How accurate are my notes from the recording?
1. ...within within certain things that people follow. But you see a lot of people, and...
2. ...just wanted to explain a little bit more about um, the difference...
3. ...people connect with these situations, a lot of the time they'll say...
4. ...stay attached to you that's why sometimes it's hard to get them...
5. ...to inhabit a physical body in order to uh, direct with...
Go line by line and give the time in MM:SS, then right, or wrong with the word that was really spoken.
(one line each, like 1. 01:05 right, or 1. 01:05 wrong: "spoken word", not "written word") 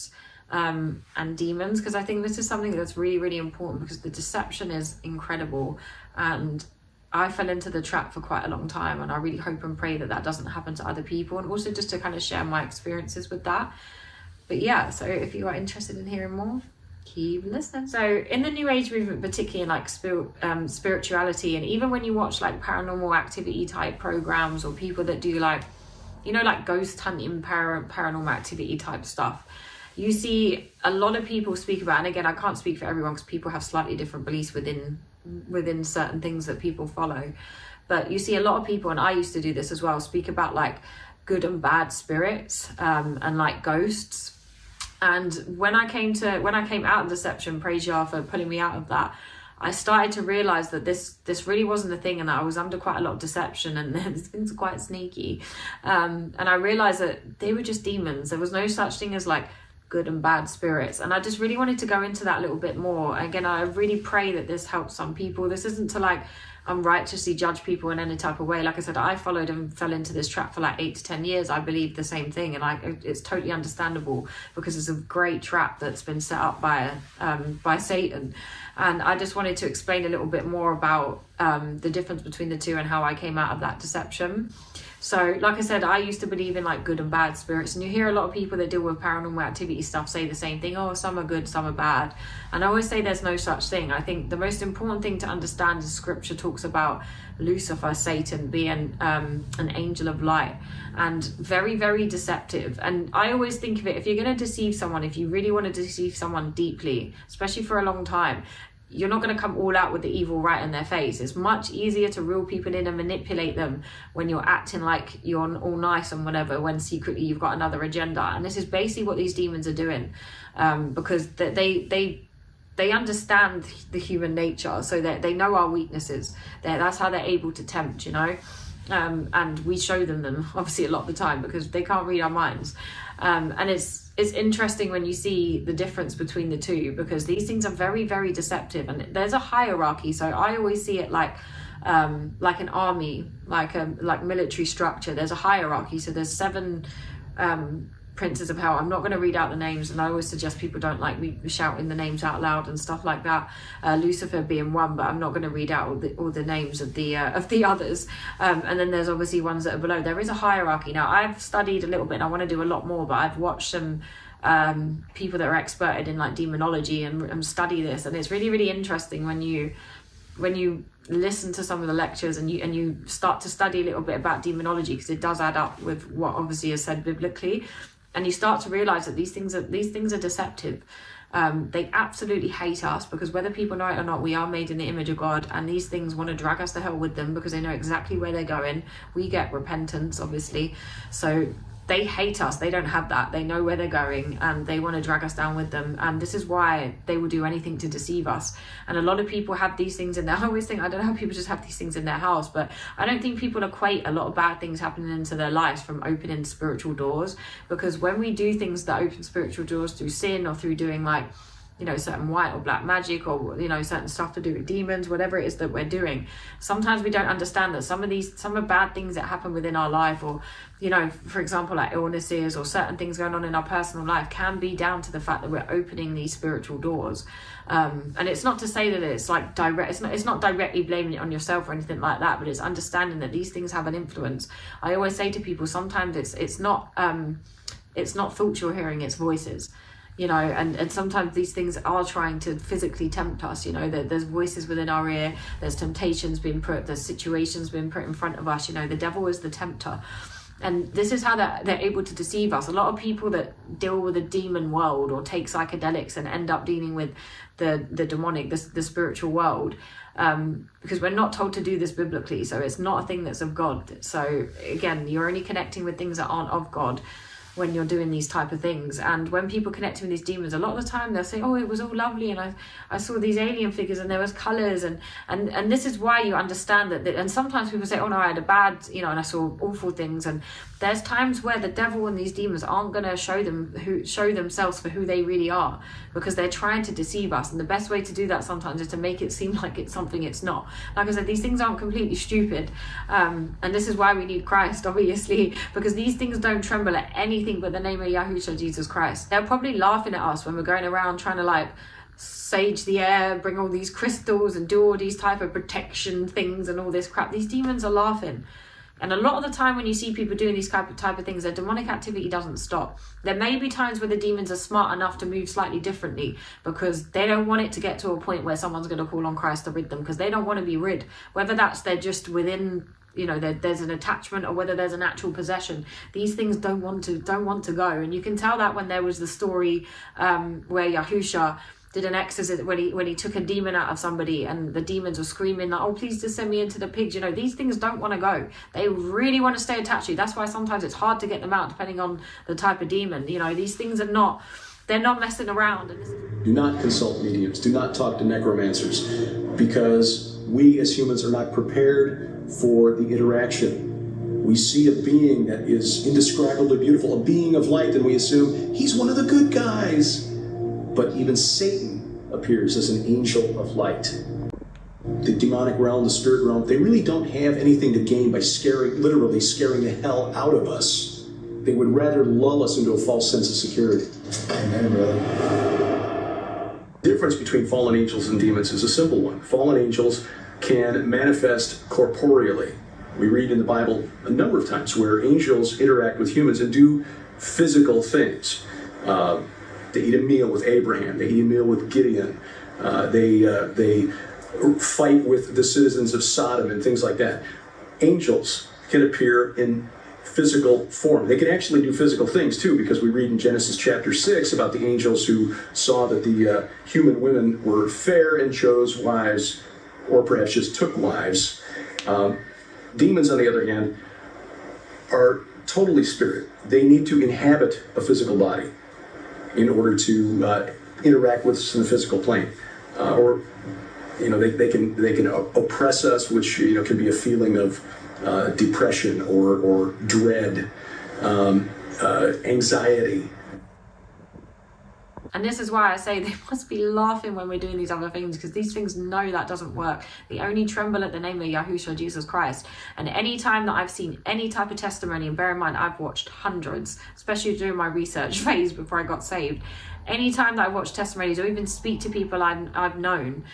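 1. 00:34 right
2. 01:19 right
3. 04:29 wrong: "demons", not "situations"
4. 05:39 right
5. 06:57 wrong: "interact", not "direct".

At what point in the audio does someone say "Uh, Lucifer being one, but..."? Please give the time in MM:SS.
02:33.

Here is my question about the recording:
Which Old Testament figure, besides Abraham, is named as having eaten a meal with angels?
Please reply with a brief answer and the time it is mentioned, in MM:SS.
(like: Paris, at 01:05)
Gideon, at 06:31.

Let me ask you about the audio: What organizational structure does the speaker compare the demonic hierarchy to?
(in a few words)
Military structure.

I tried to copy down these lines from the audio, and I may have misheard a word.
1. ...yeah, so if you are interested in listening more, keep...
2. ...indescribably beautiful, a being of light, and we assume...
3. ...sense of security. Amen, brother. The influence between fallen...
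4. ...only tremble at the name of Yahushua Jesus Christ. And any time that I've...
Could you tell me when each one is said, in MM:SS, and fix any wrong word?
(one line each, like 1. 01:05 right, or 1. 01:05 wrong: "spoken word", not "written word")
1. 00:14 wrong: "hearing", not "listening"
2. 05:56 right
3. 06:13 wrong: "difference", not "influence"
4. 07:20 right.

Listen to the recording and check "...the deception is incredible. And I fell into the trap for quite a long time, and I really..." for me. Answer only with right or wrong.
right.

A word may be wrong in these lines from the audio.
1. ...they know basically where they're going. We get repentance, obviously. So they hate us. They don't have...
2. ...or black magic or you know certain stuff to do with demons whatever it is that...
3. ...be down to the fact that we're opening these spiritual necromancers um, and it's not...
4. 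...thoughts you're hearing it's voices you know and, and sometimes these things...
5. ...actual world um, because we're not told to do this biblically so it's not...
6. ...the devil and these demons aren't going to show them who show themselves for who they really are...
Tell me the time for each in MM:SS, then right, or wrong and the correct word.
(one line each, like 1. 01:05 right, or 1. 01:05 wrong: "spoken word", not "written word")
1. 03:07 wrong: "exactly", not "basically"
2. 03:32 right
3. 03:44 wrong: "doors", not "necromancers"
4. 03:58 right
5. 04:18 wrong: "spiritual", not "actual"
6. 04:41 right.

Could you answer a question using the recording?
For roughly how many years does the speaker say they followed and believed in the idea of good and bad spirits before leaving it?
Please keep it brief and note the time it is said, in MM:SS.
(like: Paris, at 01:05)
8 to 10 years, at 01:10.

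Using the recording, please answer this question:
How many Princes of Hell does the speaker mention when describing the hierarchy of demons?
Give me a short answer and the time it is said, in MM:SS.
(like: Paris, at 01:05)
7, at 02:26.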